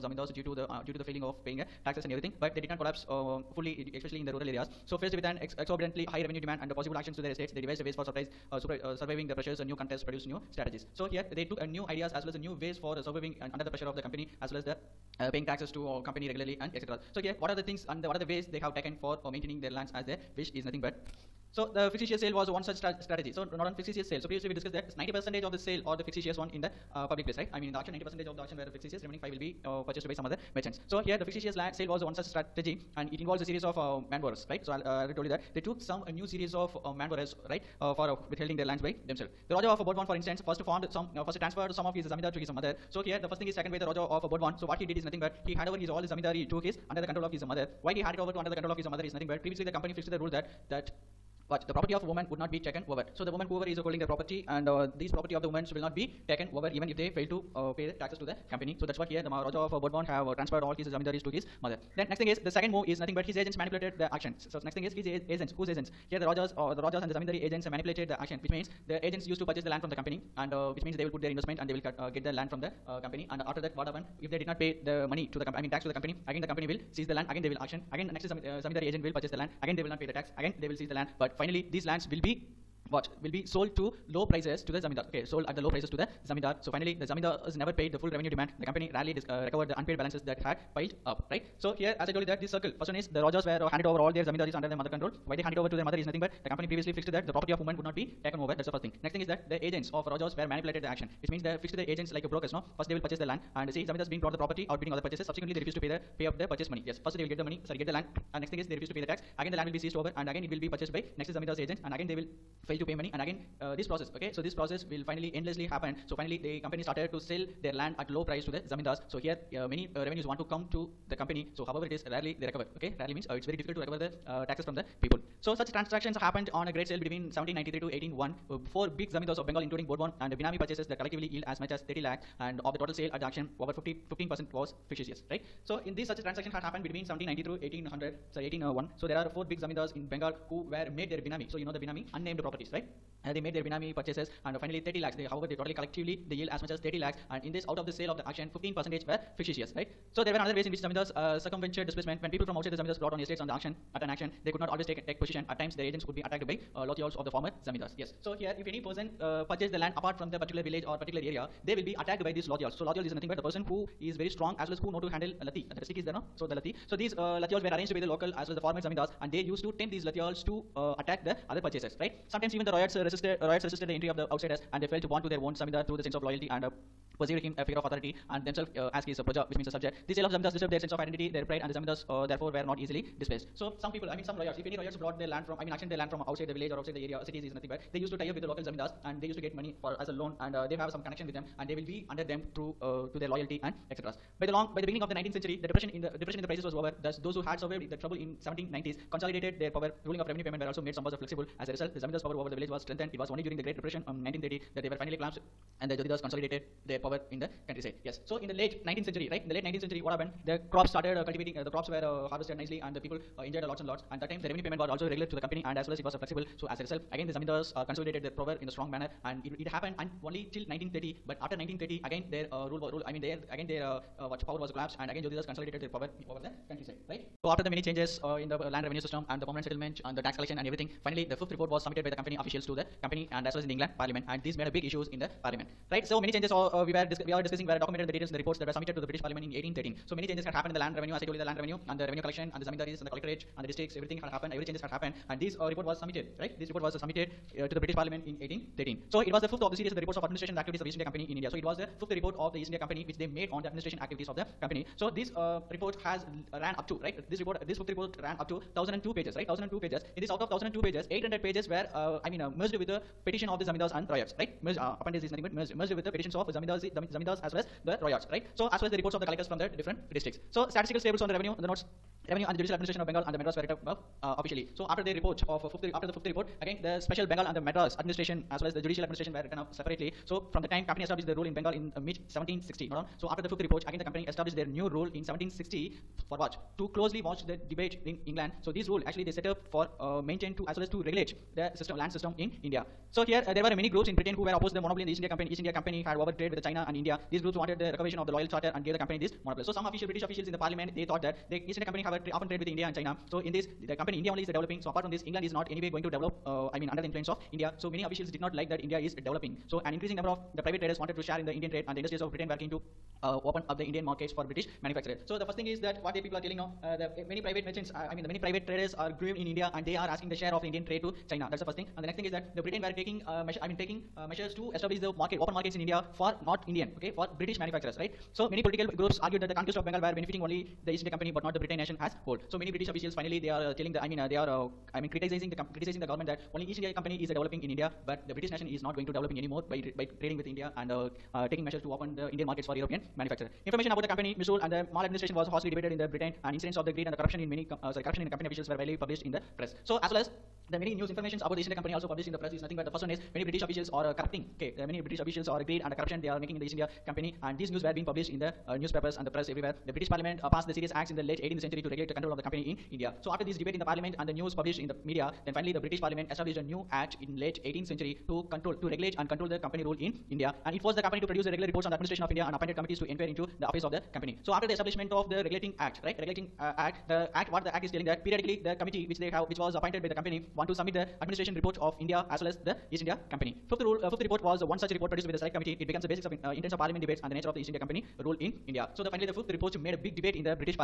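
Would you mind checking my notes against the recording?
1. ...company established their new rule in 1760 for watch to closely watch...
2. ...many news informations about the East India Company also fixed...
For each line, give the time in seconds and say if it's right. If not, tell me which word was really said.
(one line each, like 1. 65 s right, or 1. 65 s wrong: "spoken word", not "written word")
1. 284 s right
2. 350 s wrong: "published", not "fixed".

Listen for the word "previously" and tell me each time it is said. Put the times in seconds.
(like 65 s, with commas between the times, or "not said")
24 s, 49 s, 96 s.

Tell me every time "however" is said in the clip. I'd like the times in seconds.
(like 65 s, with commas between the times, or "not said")
121 s, 145 s.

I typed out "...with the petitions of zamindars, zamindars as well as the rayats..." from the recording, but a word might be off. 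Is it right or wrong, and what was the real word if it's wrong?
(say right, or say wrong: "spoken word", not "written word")
right.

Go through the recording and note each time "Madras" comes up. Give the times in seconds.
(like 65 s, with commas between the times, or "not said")
273 s, 277 s.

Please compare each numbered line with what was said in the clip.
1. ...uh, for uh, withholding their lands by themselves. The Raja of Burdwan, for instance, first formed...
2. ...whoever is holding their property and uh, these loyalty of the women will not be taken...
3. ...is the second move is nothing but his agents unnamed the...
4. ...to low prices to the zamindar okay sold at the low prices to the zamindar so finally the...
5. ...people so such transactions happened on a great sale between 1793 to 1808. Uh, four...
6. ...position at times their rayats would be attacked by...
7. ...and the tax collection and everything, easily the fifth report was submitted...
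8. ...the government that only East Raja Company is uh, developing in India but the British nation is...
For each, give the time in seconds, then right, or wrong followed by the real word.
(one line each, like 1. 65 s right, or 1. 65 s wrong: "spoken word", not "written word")
1. 37 s right
2. 53 s wrong: "property", not "loyalty"
3. 62 s wrong: "manipulated", not "unnamed"
4. 83 s right
5. 125 s wrong: "1801", not "1808"
6. 155 s wrong: "agents", not "rayats"
7. 230 s wrong: "finally", not "easily"
8. 336 s wrong: "India", not "Raja".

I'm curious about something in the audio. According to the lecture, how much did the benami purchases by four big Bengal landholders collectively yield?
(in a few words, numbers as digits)
30 lakh.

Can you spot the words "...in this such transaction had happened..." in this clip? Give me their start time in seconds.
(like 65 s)
135 s.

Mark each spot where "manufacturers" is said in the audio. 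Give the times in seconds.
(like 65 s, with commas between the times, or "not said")
314 s, 327 s, 343 s.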